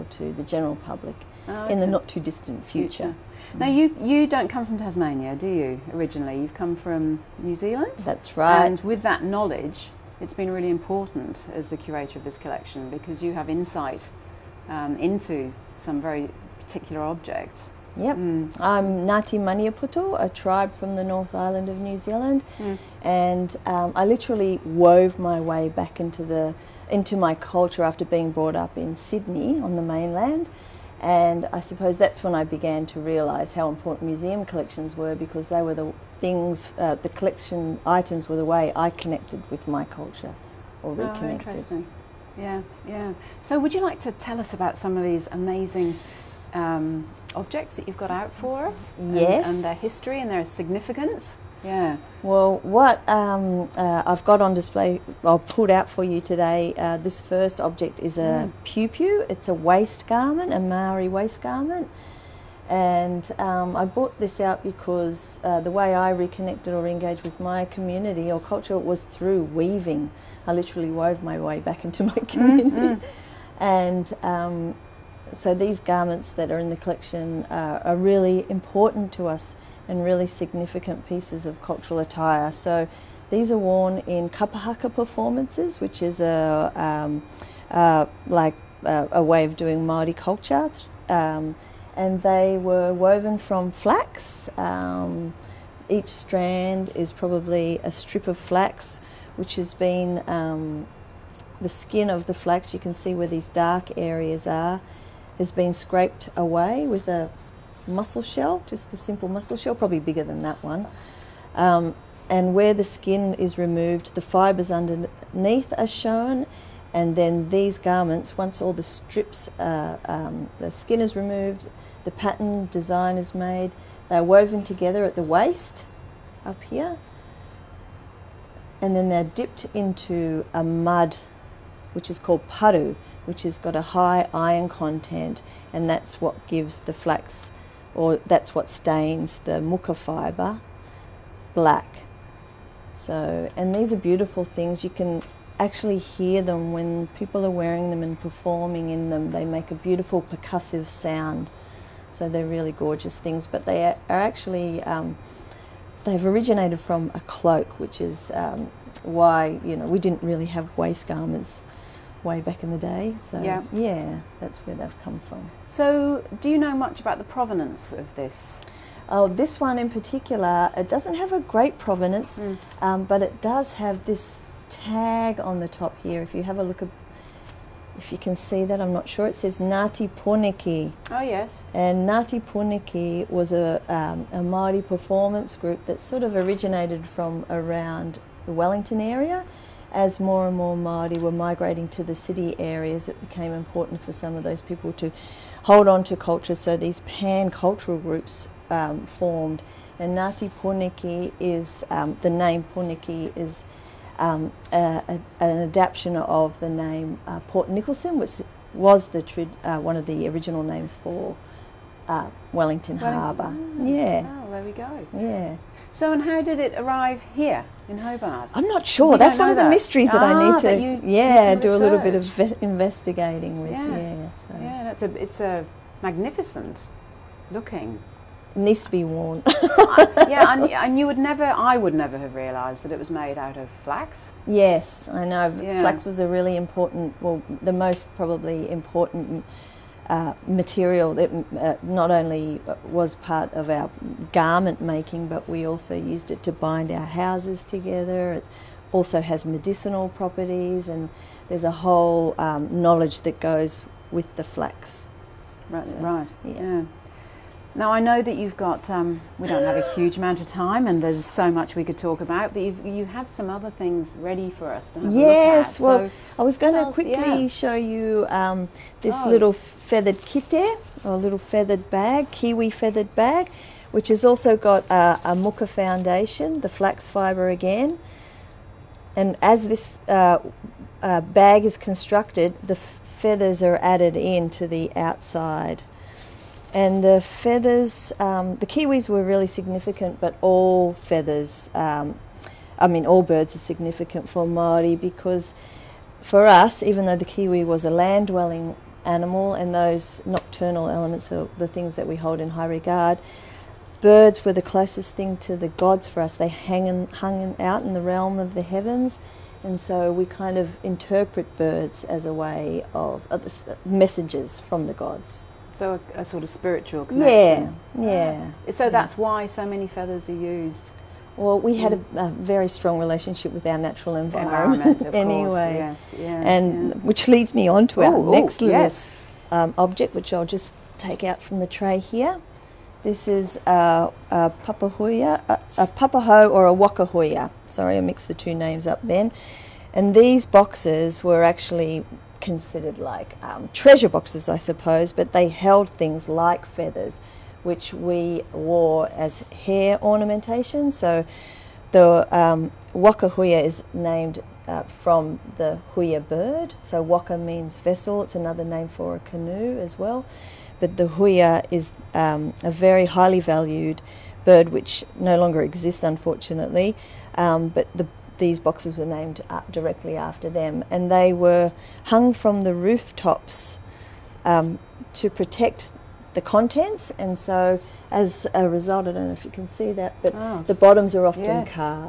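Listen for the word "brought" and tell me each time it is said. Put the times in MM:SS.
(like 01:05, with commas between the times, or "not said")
00:28, 01:03.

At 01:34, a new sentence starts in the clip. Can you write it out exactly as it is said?
Um, each strand is probably a strip of flax, which has been um, the skin of the flax.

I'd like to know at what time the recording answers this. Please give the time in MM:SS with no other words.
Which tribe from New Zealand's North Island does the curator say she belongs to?
00:19.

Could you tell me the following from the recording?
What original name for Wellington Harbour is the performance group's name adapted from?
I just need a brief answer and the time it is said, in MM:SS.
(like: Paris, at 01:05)
Port Nicholson, at 03:27.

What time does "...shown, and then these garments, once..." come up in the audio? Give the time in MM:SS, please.
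01:55.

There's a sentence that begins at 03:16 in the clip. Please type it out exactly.
So these pan-cultural groups um, formed.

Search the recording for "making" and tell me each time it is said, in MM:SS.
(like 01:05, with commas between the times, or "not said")
04:04.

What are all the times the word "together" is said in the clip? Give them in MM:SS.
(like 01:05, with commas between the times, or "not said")
02:04, 04:07.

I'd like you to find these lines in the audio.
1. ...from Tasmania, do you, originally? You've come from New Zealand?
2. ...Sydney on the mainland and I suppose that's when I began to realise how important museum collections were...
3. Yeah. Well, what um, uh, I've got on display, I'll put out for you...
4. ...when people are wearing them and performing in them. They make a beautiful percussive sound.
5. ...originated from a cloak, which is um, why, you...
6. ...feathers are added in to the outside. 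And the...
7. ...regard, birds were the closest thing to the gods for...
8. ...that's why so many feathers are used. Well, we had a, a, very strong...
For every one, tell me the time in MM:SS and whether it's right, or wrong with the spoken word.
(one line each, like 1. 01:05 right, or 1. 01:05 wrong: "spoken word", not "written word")
1. 00:04 right
2. 00:28 right
3. 00:51 right
4. 02:26 right
5. 02:36 right
6. 04:42 right
7. 05:02 right
8. 05:18 right.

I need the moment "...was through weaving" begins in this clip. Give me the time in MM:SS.
01:08.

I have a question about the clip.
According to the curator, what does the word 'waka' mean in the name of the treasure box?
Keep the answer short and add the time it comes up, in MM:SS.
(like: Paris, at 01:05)
vessel, at 05:57.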